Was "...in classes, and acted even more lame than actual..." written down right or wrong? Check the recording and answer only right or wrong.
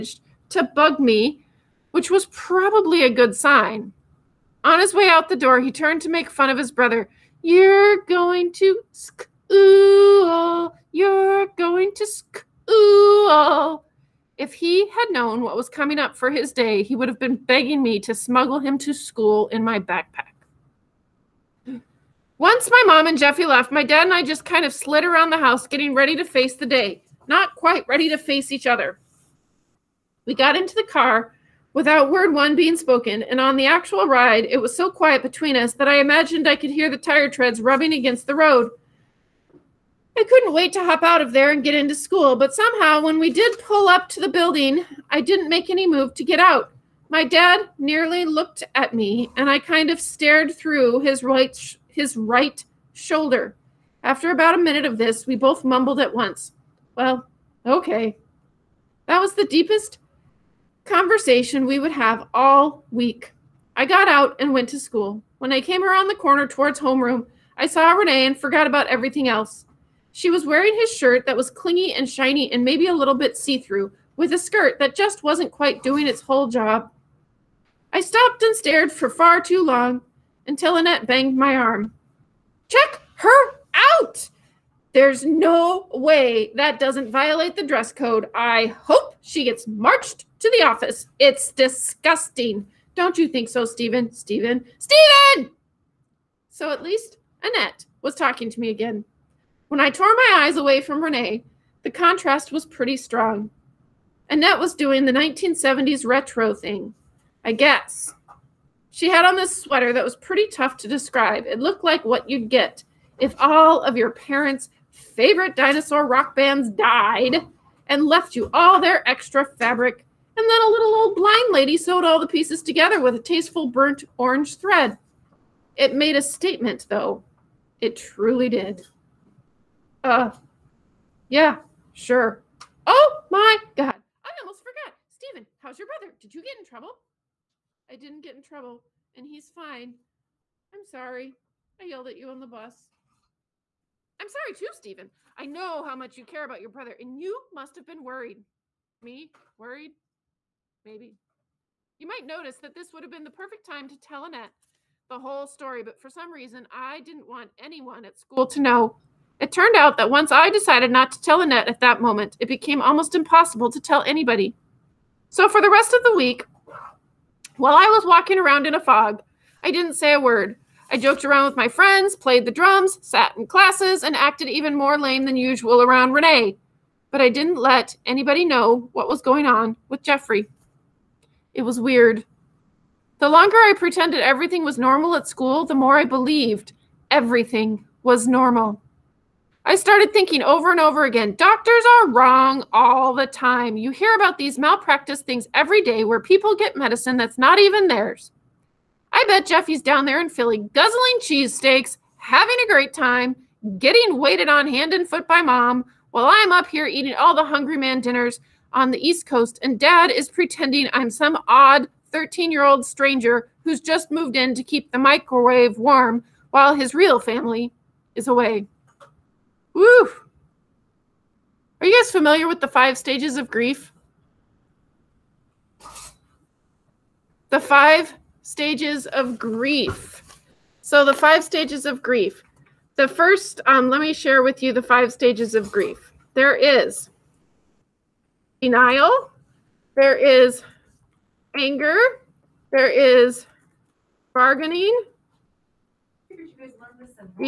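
wrong.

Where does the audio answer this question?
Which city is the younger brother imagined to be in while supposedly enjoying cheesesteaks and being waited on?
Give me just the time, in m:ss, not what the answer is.
3:20.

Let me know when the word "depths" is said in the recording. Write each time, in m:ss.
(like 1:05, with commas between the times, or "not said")
not said.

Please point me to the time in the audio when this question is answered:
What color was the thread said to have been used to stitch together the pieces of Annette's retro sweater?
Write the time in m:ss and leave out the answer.
2:03.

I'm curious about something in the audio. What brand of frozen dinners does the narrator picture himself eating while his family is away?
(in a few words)
Hungry Man.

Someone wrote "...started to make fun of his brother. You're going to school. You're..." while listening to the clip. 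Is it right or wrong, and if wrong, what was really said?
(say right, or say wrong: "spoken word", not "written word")
wrong: "turned", not "started".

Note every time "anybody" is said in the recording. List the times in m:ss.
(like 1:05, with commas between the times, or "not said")
2:44, 2:58.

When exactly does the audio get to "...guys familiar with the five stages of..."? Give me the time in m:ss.
3:42.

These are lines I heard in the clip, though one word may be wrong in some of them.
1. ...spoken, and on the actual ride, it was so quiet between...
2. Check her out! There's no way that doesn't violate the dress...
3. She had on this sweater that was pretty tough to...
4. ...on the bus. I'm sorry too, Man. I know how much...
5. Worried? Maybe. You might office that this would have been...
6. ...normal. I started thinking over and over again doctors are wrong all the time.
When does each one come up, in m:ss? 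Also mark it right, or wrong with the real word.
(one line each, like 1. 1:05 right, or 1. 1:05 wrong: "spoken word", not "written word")
1. 0:32 right
2. 1:22 right
3. 1:48 right
4. 2:22 wrong: "Steven", not "Man"
5. 2:29 wrong: "notice", not "office"
6. 3:08 right.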